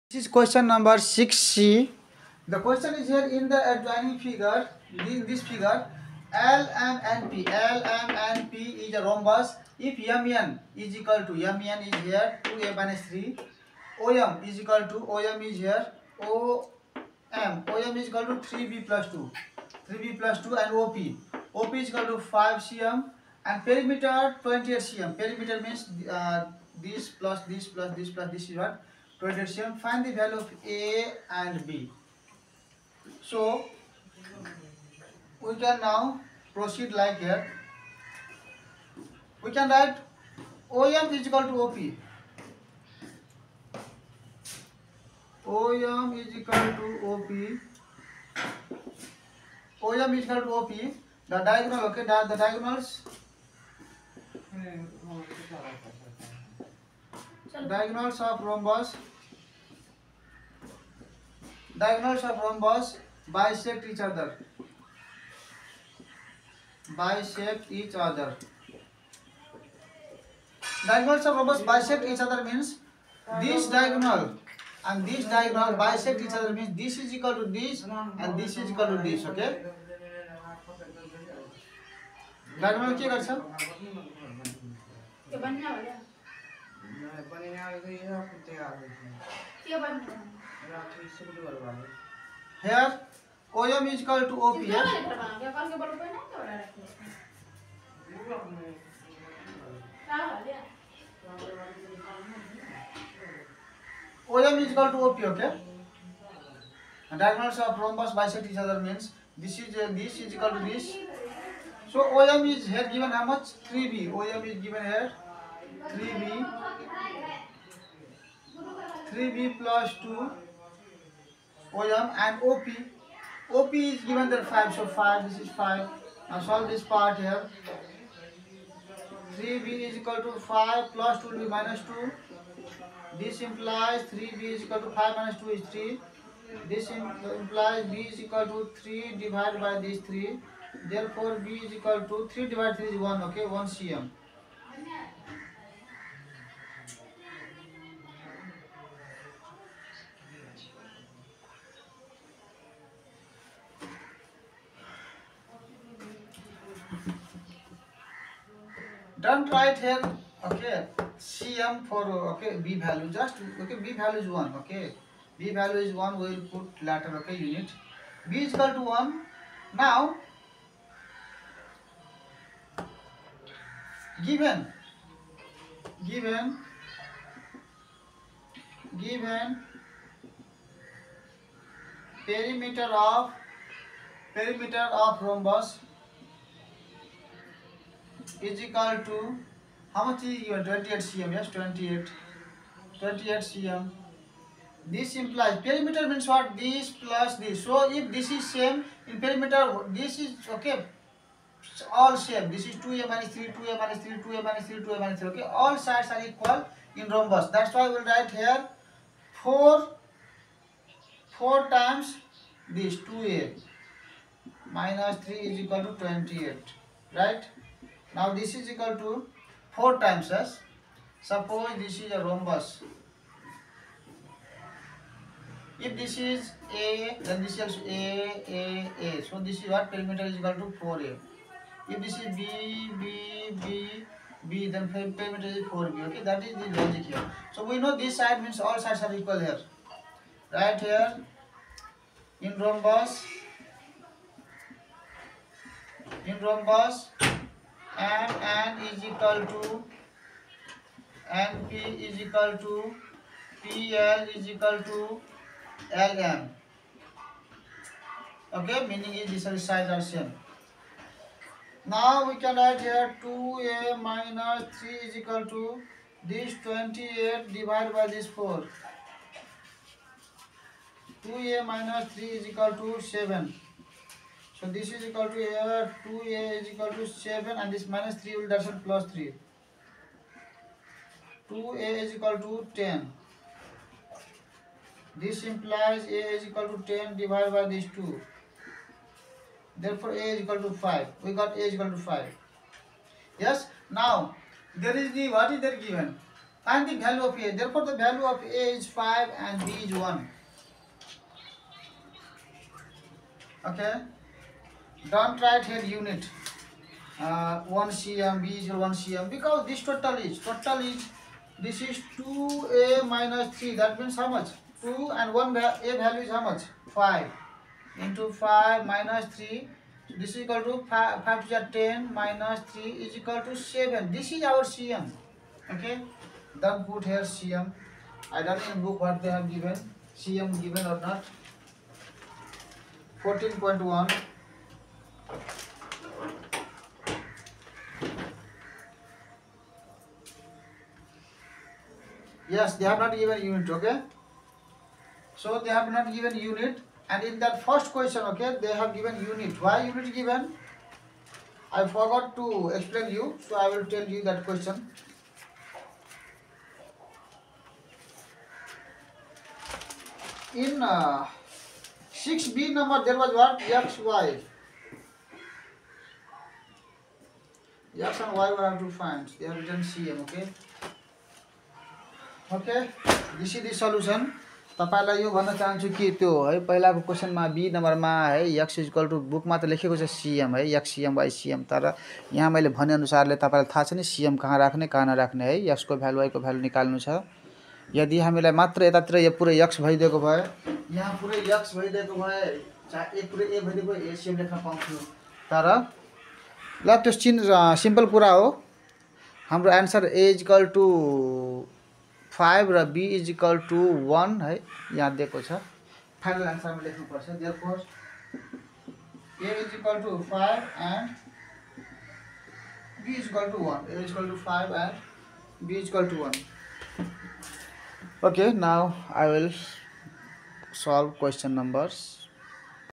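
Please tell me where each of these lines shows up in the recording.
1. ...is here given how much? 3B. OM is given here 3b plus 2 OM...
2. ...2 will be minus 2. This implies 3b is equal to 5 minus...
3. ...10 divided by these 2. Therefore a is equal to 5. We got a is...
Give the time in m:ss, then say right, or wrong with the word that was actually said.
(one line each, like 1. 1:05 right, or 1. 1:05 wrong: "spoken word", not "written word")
1. 1:52 right
2. 2:11 right
3. 4:46 right.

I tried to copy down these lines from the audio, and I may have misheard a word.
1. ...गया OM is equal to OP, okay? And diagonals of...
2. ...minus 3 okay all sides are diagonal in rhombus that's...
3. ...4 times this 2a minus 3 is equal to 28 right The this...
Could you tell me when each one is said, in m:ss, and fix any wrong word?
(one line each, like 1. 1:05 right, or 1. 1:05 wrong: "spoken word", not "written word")
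1. 1:40 right
2. 3:24 wrong: "equal", not "diagonal"
3. 3:31 wrong: "Now", not "The".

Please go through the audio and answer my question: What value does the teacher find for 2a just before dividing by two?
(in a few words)
10.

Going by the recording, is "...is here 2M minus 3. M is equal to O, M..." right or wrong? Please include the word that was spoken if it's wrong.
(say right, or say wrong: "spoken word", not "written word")
right.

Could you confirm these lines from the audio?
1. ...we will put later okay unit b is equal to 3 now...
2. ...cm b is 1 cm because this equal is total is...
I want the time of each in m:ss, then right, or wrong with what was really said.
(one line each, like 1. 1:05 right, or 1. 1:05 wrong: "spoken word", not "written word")
1. 2:46 wrong: "1", not "3"
2. 5:07 wrong: "total", not "equal".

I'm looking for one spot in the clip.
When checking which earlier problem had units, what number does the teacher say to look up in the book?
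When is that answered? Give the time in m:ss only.
5:33.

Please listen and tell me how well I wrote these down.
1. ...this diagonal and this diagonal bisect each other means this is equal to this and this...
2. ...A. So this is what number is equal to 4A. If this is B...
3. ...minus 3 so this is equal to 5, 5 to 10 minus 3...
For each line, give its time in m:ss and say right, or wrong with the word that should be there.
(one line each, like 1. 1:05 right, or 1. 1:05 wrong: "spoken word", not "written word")
1. 1:13 right
2. 3:49 wrong: "perimeter", not "number"
3. 5:18 right.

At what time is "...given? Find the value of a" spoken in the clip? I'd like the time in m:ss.
4:55.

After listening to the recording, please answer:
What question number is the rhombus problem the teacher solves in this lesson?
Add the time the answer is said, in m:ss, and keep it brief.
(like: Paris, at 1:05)
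6C, at 0:00.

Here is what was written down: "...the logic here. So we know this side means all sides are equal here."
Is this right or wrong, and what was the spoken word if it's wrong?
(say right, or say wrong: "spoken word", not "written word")
right.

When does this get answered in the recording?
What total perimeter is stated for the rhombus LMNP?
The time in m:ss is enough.
0:23.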